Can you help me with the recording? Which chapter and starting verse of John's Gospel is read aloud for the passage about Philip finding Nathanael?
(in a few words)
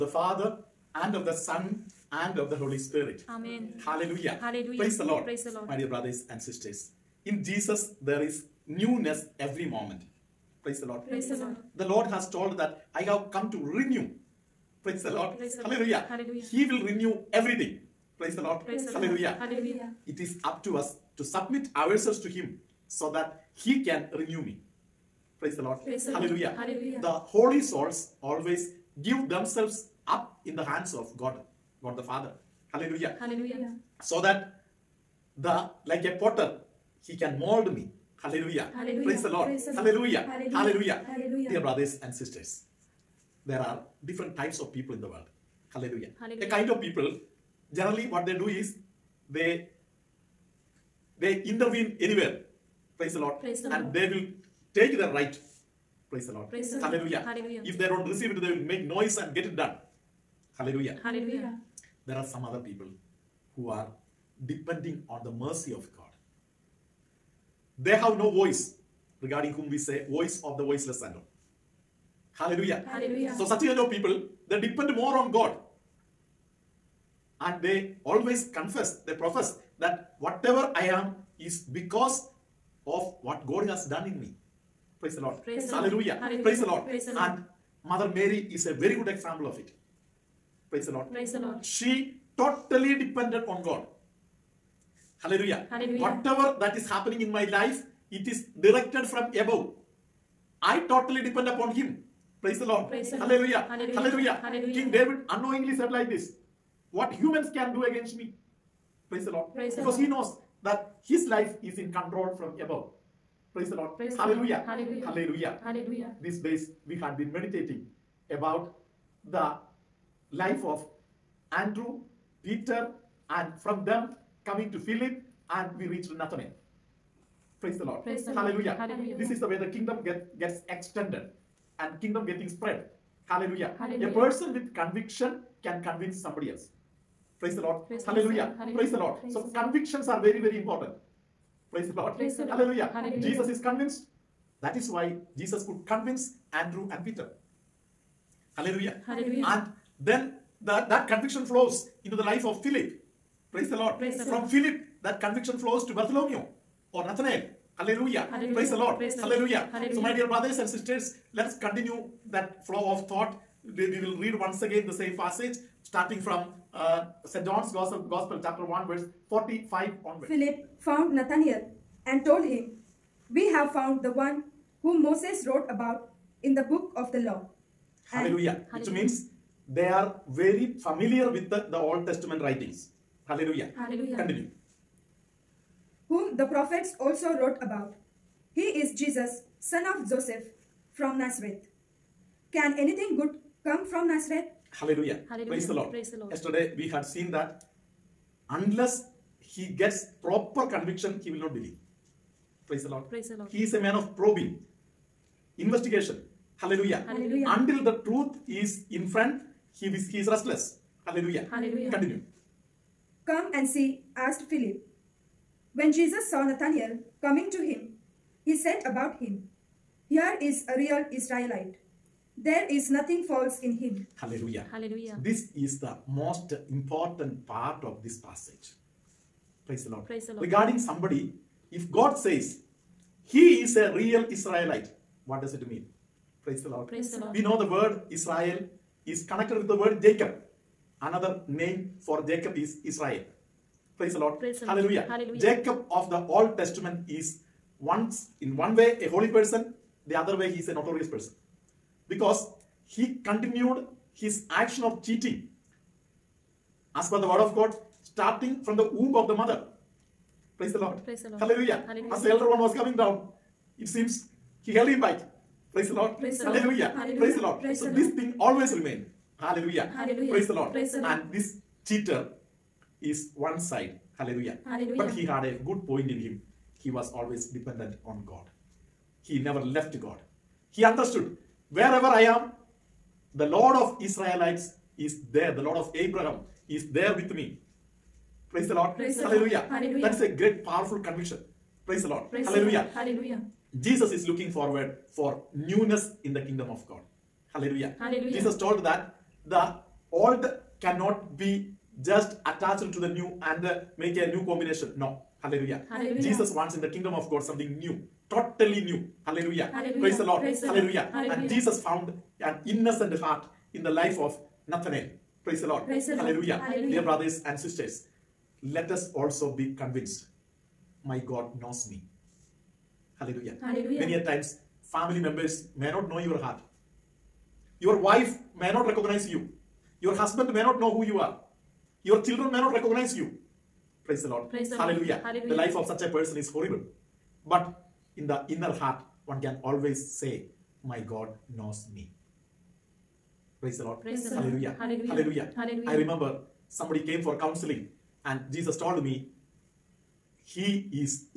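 Chapter 1, verse 45.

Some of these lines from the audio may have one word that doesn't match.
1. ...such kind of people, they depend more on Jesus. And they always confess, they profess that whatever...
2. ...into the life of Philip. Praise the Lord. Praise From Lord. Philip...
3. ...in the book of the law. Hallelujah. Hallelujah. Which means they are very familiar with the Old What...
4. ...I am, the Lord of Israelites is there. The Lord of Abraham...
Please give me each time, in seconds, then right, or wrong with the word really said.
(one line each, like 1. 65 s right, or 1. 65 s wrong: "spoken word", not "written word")
1. 73 s wrong: "God", not "Jesus"
2. 152 s right
3. 176 s wrong: "Testament", not "What"
4. 282 s right.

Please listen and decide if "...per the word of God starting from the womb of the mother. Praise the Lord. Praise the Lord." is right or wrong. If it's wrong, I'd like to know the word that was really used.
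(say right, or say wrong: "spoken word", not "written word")
right.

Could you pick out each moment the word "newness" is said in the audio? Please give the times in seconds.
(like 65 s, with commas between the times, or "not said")
8 s, 295 s.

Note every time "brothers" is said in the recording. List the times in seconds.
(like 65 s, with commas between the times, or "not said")
5 s, 41 s, 160 s, 317 s.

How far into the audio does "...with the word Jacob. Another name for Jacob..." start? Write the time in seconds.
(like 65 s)
239 s.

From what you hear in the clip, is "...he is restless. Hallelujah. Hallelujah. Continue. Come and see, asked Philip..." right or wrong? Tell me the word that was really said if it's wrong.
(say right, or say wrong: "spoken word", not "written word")
right.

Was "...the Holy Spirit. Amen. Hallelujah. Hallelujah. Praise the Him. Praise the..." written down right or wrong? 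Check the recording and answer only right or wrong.
wrong.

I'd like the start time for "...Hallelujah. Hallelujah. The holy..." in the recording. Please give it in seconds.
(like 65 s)
26 s.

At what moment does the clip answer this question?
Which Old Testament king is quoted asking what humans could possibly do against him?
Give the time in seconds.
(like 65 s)
104 s.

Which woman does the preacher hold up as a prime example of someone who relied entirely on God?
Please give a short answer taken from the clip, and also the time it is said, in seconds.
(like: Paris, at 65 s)
Mother Mary, at 87 s.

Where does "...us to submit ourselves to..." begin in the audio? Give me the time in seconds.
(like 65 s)
20 s.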